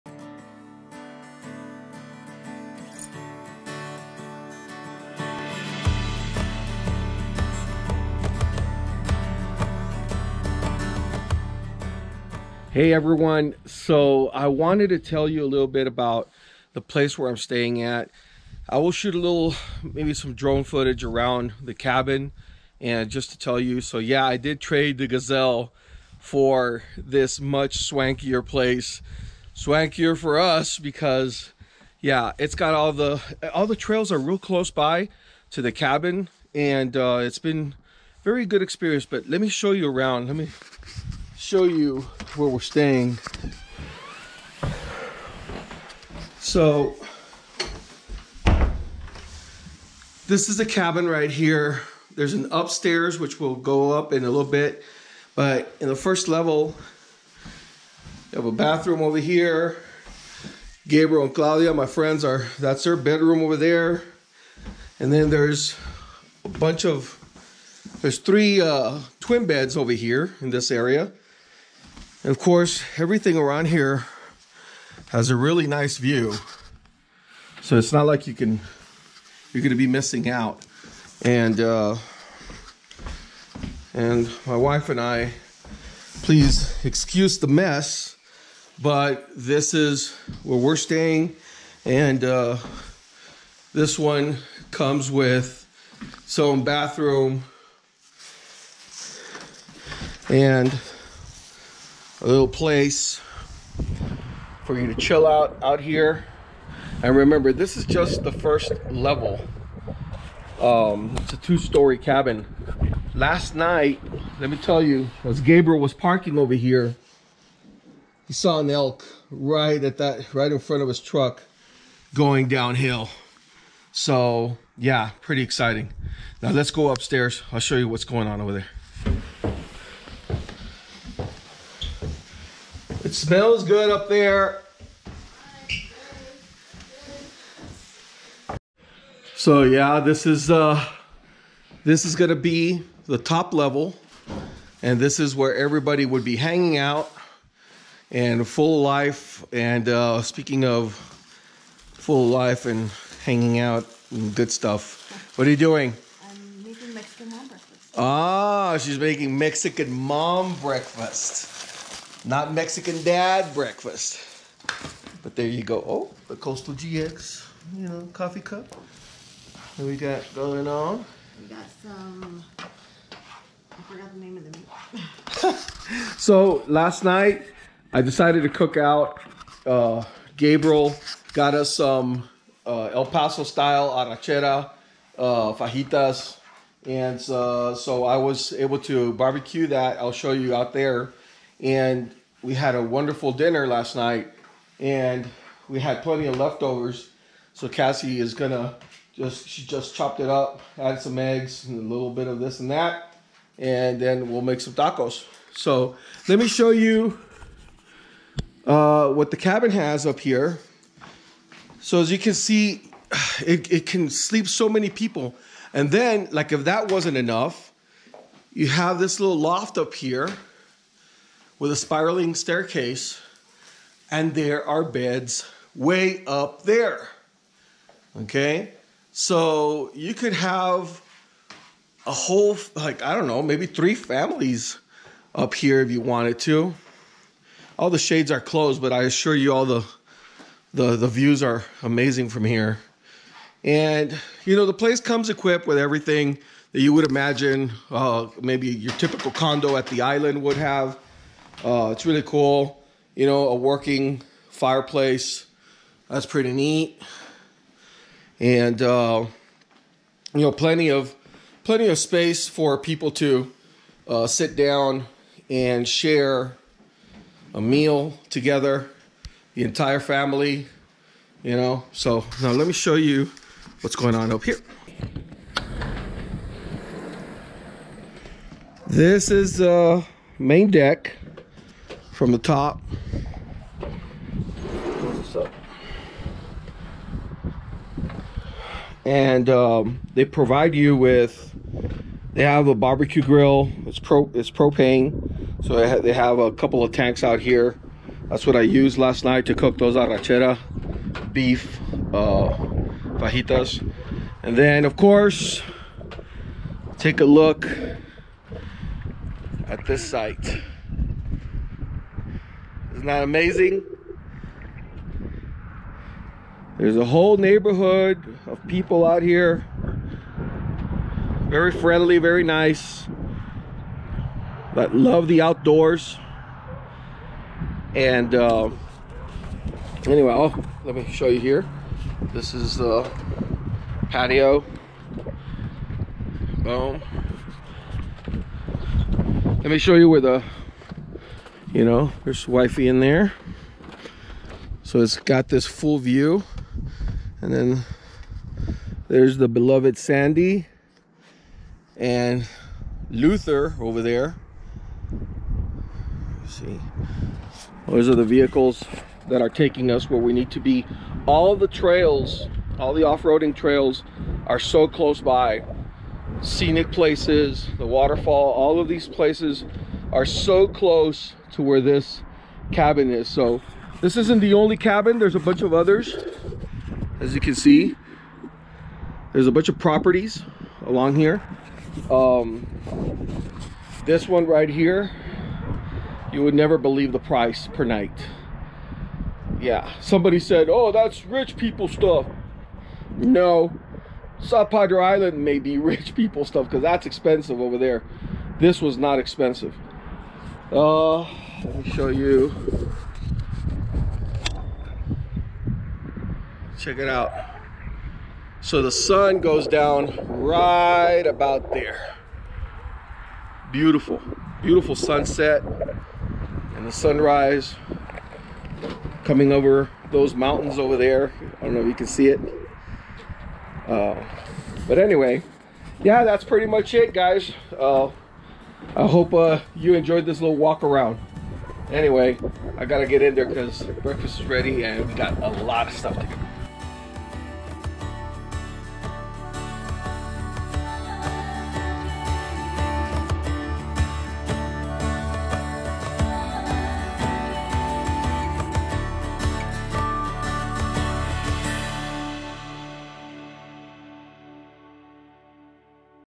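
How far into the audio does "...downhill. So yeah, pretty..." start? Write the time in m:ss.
2:02.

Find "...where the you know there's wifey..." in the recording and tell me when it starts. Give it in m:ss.
5:40.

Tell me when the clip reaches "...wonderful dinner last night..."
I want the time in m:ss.
3:12.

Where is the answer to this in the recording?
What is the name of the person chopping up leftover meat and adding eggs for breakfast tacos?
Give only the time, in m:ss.
3:17.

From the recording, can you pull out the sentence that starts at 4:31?
You know, so now let me show you what's going on up here.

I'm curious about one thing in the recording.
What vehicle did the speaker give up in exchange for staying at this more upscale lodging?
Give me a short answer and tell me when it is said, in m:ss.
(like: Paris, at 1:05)
The Gazelle, at 0:25.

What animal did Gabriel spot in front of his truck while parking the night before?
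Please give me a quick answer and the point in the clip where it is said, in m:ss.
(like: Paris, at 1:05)
An elk, at 1:58.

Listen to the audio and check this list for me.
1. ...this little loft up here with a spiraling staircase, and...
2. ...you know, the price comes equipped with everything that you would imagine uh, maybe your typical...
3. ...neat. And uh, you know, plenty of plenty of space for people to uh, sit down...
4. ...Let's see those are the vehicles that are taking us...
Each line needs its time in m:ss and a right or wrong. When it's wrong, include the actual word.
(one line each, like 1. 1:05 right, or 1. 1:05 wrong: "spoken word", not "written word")
1. 3:38 right
2. 4:04 wrong: "place", not "price"
3. 4:16 right
4. 5:56 right.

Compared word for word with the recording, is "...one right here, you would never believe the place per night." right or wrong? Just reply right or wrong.
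wrong.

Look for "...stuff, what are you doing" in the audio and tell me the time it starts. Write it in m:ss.
2:34.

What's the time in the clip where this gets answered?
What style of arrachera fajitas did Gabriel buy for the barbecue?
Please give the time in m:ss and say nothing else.
3:02.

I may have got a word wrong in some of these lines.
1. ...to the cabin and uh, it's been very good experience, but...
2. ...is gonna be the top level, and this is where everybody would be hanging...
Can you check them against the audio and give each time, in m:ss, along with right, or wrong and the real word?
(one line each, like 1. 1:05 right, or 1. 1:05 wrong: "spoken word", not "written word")
1. 0:35 right
2. 2:22 right.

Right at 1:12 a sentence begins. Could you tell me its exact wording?
And of course, everything around here has a really nice view.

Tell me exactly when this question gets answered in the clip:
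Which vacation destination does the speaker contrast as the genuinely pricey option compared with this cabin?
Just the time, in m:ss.
6:34.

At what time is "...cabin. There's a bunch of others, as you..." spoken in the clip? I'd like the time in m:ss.
6:14.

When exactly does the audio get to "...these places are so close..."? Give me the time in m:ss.
6:08.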